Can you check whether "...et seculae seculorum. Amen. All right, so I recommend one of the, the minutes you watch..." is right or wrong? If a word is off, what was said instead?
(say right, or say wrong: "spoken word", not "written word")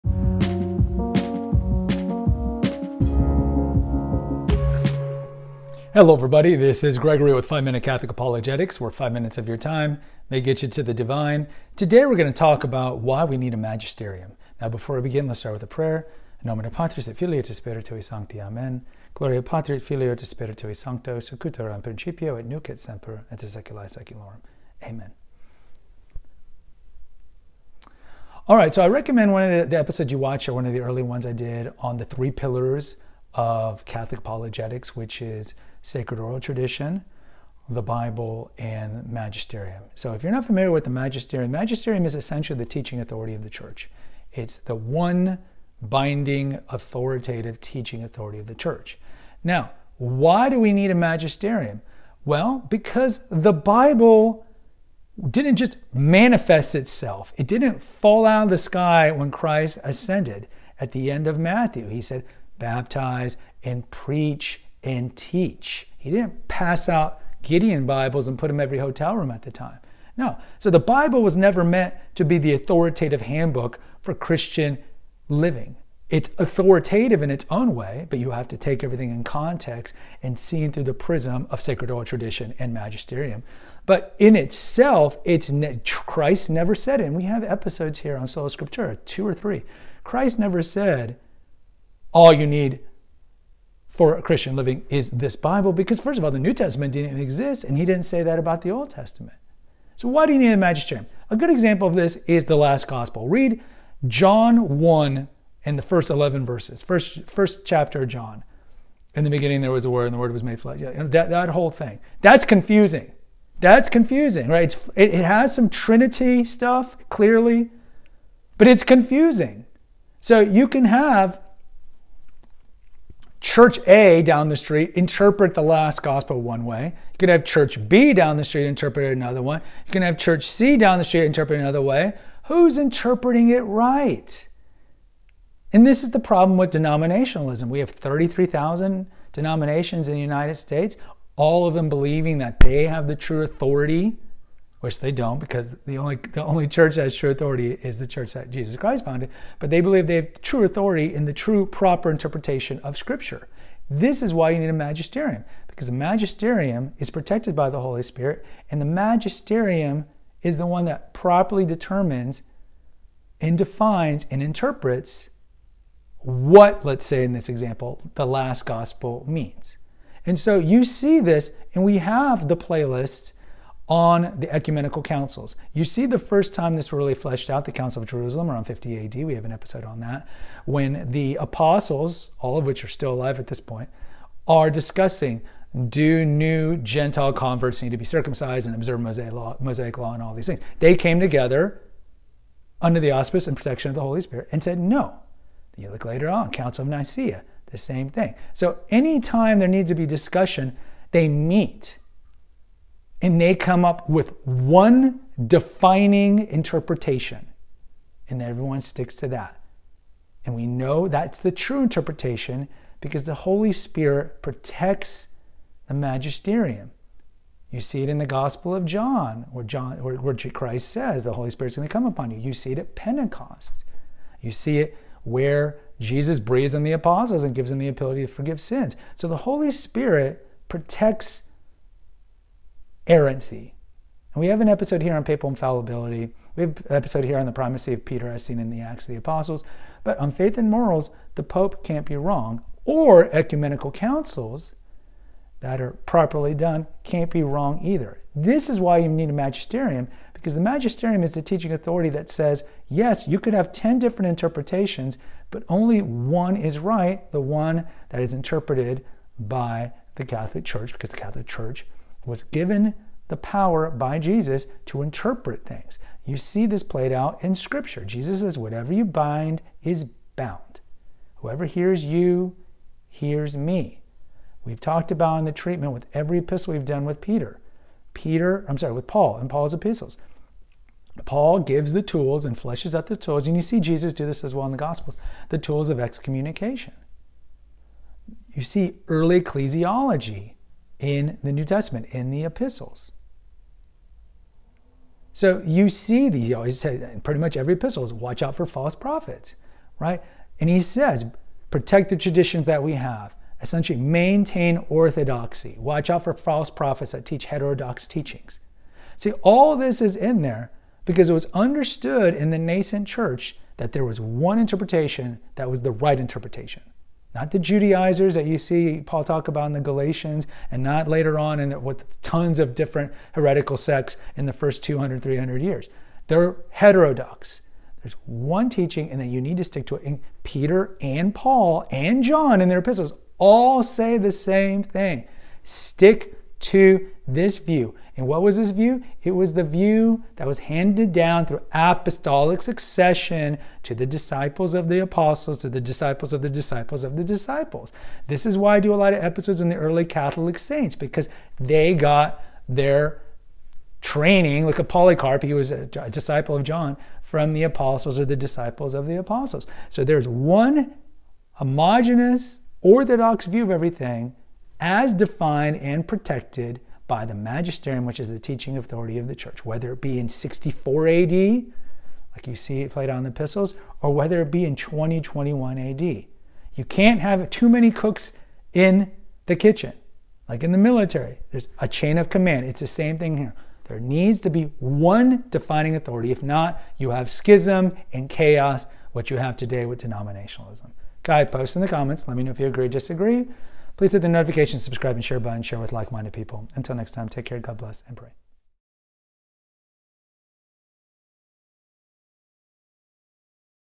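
wrong: "episodes", not "minutes".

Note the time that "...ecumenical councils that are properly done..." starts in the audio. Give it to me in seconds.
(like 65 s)
243 s.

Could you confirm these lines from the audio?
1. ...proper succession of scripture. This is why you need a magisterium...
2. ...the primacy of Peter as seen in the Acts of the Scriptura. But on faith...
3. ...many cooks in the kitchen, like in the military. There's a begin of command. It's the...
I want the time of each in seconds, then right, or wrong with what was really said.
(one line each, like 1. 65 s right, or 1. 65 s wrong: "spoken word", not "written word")
1. 151 s wrong: "interpretation", not "succession"
2. 237 s wrong: "Apostles", not "Scriptura"
3. 377 s wrong: "chain", not "begin".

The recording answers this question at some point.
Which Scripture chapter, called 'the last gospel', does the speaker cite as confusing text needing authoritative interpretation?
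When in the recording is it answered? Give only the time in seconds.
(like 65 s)
104 s.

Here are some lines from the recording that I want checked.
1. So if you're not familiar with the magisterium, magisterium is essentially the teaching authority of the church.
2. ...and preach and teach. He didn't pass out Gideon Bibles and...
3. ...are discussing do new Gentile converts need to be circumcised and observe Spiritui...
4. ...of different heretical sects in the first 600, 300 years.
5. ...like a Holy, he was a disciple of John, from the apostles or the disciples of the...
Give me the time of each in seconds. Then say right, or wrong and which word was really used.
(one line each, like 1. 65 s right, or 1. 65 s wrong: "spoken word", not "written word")
1. 39 s right
2. 63 s right
3. 184 s wrong: "Mosaic", not "Spiritui"
4. 322 s wrong: "200", not "600"
5. 354 s wrong: "Polycarp", not "Holy".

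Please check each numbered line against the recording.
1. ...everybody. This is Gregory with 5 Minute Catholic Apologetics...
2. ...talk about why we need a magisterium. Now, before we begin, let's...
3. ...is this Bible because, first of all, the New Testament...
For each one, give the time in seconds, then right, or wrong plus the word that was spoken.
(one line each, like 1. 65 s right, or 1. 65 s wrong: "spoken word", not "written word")
1. 6 s right
2. 12 s right
3. 94 s right.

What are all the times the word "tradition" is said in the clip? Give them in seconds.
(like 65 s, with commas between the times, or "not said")
36 s, 82 s, 302 s.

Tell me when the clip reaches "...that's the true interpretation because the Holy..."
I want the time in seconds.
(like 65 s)
211 s.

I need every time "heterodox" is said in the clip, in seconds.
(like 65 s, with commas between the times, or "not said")
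307 s, 326 s.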